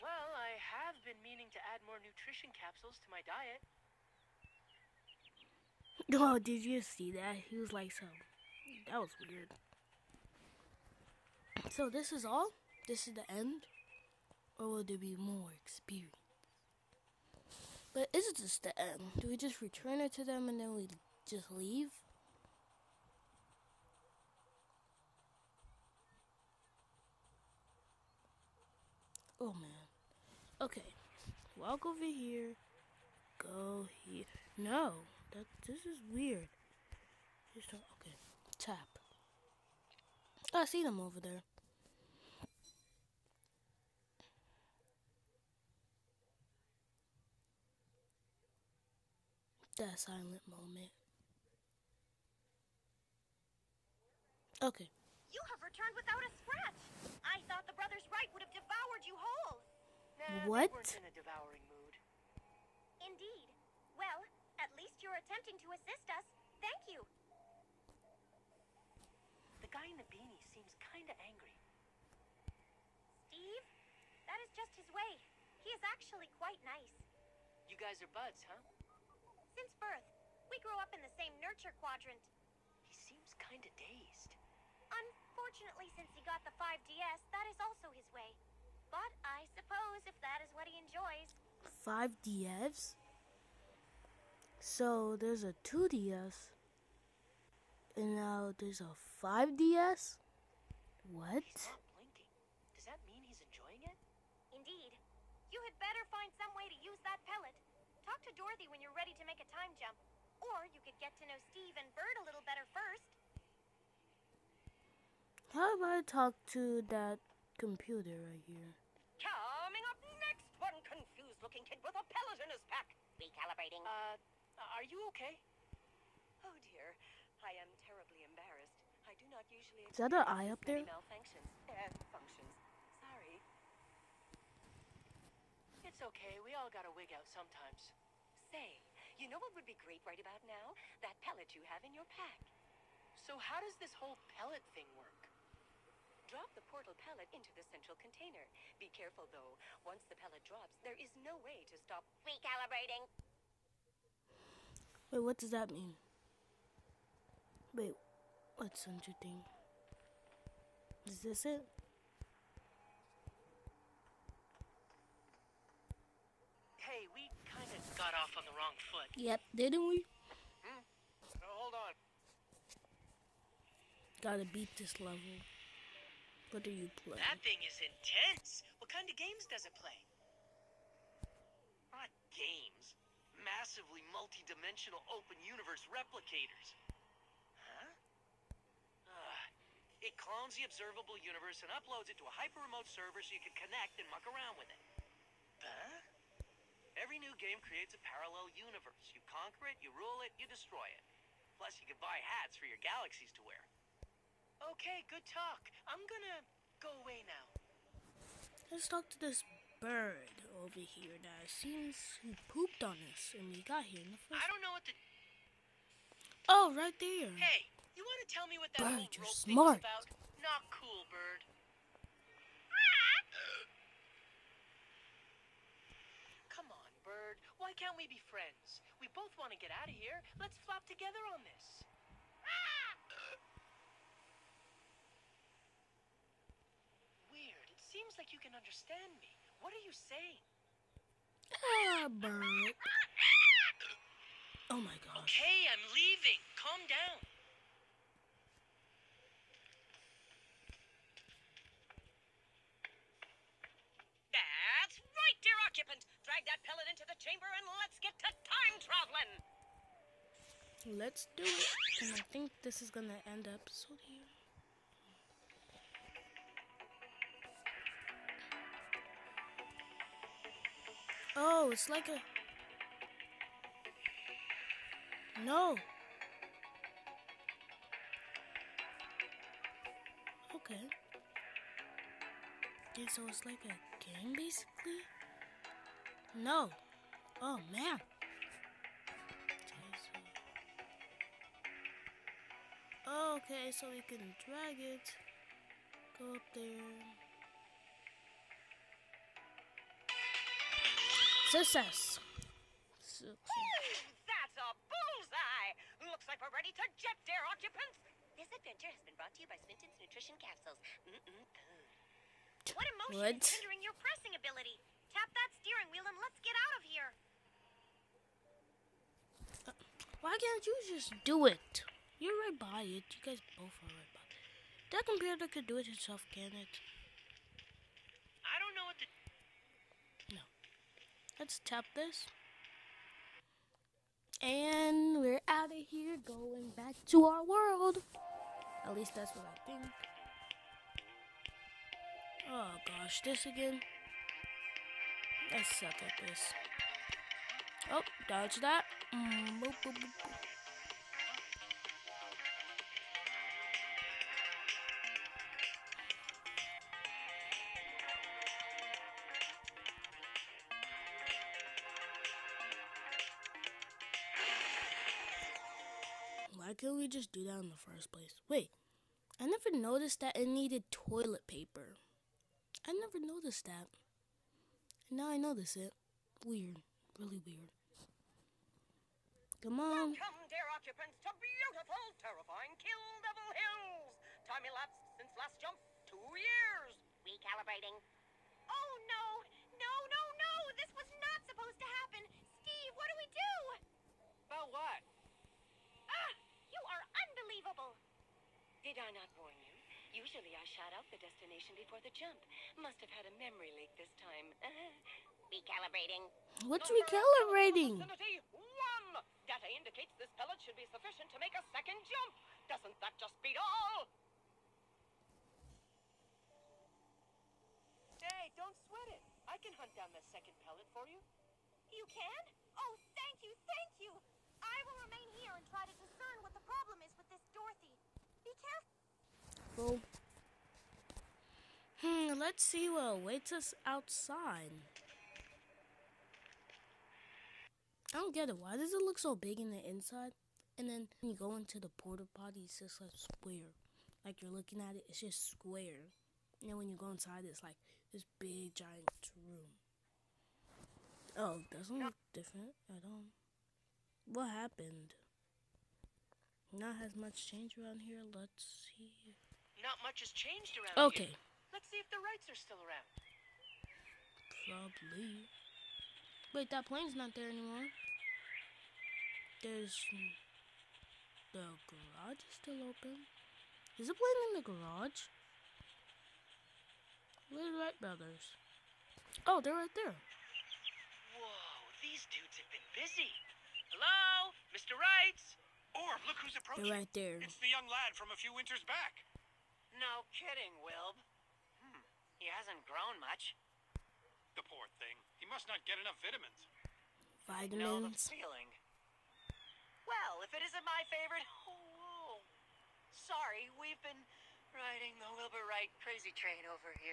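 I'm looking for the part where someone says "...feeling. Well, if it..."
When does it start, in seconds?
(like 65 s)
498 s.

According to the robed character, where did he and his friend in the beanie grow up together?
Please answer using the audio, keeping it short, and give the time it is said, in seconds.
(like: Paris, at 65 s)
nurture quadrant, at 81 s.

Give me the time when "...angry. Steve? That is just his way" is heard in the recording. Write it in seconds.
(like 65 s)
71 s.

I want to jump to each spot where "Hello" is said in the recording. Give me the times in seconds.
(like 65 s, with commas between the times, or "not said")
483 s.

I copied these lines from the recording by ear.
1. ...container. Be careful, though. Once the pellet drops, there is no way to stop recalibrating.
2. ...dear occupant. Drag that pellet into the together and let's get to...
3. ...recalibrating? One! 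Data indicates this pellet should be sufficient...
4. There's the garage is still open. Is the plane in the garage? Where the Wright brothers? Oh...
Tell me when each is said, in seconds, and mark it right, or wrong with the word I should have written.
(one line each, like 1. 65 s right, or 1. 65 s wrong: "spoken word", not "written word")
1. 147 s right
2. 255 s wrong: "chamber", not "together"
3. 406 s right
4. 469 s right.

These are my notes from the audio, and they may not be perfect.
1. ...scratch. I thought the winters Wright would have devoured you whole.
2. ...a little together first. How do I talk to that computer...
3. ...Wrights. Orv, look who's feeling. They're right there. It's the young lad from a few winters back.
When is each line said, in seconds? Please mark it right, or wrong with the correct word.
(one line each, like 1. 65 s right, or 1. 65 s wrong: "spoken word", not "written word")
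1. 56 s wrong: "brothers", not "winters"
2. 112 s wrong: "better", not "together"
3. 484 s wrong: "approaching", not "feeling".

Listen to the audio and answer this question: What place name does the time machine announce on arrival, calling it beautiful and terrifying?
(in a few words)
Kill Devil Hills.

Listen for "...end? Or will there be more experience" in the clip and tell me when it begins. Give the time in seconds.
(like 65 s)
13 s.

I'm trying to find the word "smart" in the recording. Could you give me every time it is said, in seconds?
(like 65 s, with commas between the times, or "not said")
219 s.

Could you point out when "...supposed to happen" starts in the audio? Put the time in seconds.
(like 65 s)
391 s.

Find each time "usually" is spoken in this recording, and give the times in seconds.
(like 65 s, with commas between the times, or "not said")
129 s, 400 s.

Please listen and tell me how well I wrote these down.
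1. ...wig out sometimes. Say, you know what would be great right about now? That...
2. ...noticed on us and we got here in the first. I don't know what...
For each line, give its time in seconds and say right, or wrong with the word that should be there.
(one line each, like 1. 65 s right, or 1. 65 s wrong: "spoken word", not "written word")
1. 136 s right
2. 212 s wrong: "pooped", not "noticed".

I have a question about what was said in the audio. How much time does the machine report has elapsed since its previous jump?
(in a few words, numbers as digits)
2 years.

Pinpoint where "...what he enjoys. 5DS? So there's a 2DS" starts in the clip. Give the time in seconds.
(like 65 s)
90 s.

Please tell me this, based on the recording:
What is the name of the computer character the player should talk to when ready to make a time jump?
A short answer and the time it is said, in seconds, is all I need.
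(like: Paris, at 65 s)
Dorothy, at 108 s.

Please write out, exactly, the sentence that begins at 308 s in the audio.
This adventure has been brought to you by Nutrition Capsules.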